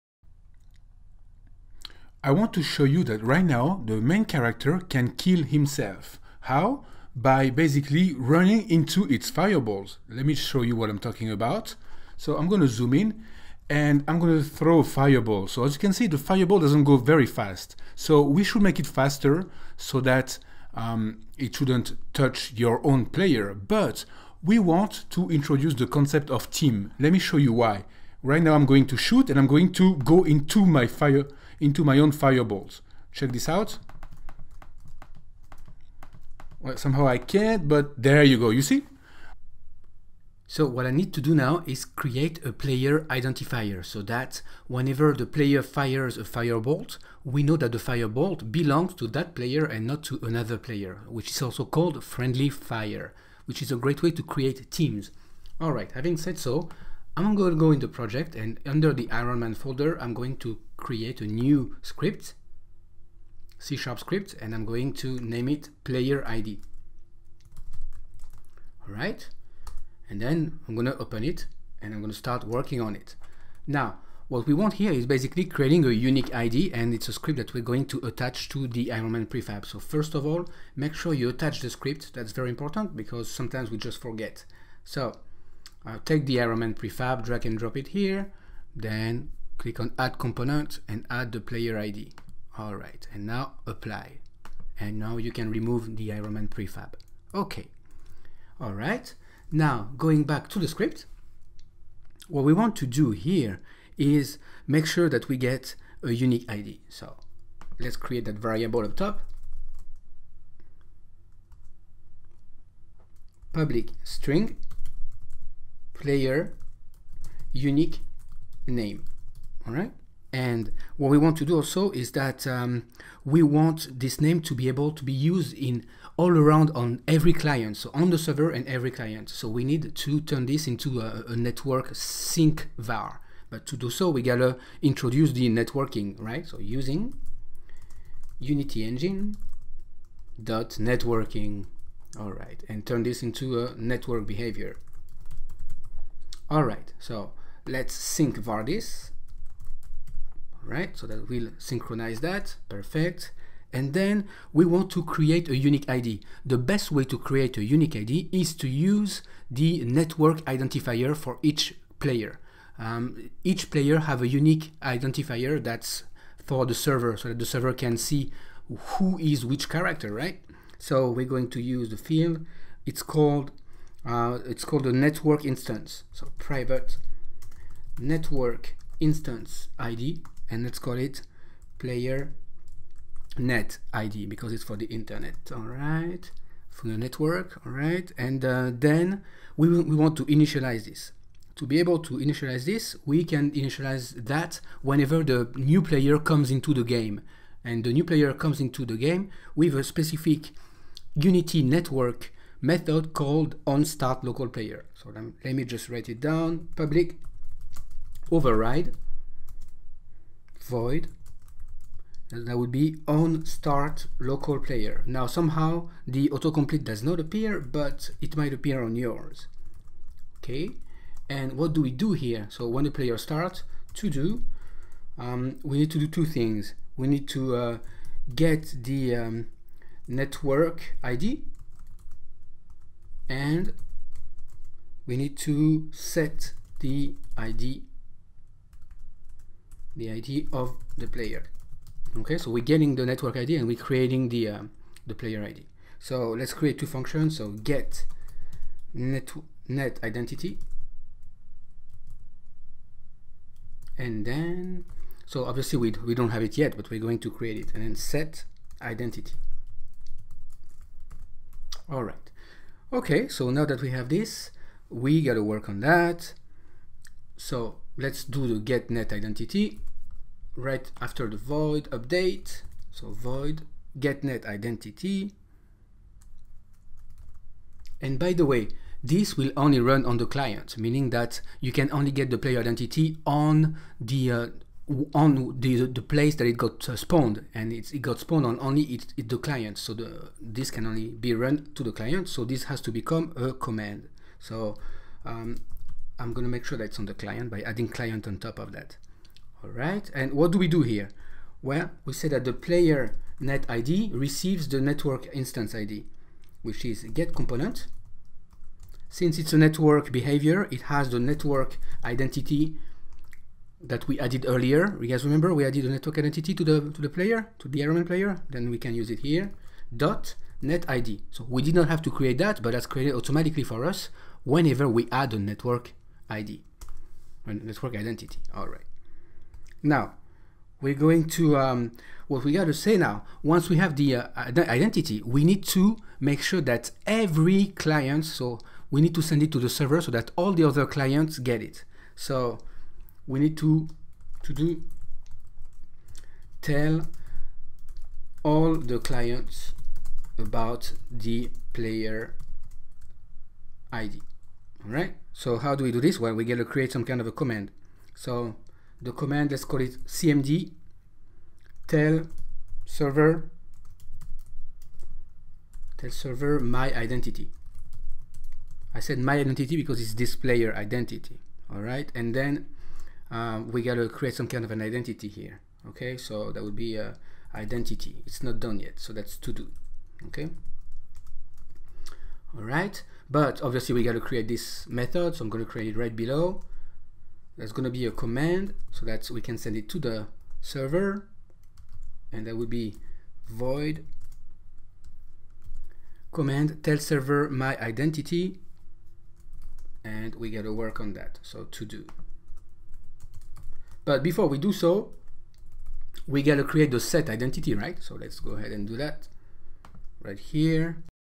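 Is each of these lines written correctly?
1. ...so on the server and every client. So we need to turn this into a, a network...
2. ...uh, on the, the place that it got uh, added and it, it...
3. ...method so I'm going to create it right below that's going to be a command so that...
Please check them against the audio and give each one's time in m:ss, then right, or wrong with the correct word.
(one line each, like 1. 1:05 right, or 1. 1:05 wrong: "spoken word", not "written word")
1. 2:07 right
2. 4:44 wrong: "spawned", not "added"
3. 6:24 right.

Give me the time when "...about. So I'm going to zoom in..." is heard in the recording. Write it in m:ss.
0:11.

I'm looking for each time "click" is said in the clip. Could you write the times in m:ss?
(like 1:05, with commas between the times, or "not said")
1:29.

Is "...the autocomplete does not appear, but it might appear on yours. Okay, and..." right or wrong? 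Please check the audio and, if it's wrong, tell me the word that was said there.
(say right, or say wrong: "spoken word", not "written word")
right.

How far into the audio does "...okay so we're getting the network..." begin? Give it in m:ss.
4:02.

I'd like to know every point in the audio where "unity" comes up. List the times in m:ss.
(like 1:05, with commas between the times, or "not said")
2:18, 3:21.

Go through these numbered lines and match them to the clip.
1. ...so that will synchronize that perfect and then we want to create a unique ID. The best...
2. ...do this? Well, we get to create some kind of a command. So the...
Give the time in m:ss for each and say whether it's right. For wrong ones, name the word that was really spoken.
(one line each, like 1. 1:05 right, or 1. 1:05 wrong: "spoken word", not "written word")
1. 2:30 right
2. 5:55 right.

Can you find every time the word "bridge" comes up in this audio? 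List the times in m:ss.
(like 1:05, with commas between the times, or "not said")
not said.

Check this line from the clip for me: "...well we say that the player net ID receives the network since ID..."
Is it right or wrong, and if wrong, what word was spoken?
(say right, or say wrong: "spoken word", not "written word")
wrong: "instance", not "since".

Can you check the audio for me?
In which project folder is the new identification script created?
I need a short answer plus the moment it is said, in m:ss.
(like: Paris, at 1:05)
Ironman folder, at 0:59.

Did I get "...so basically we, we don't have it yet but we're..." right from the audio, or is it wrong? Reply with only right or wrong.
wrong.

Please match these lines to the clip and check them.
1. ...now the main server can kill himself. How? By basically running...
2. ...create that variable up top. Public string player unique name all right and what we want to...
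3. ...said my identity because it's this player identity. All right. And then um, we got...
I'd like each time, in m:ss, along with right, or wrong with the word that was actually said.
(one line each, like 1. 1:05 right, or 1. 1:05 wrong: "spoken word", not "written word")
1. 0:03 wrong: "character", not "server"
2. 1:47 right
3. 6:08 right.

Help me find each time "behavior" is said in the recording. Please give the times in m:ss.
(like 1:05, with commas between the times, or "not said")
2:24, 5:10.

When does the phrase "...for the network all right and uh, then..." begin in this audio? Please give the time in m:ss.
3:06.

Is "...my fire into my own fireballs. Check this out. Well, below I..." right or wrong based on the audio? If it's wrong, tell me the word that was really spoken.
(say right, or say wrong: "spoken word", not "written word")
wrong: "somehow", not "below".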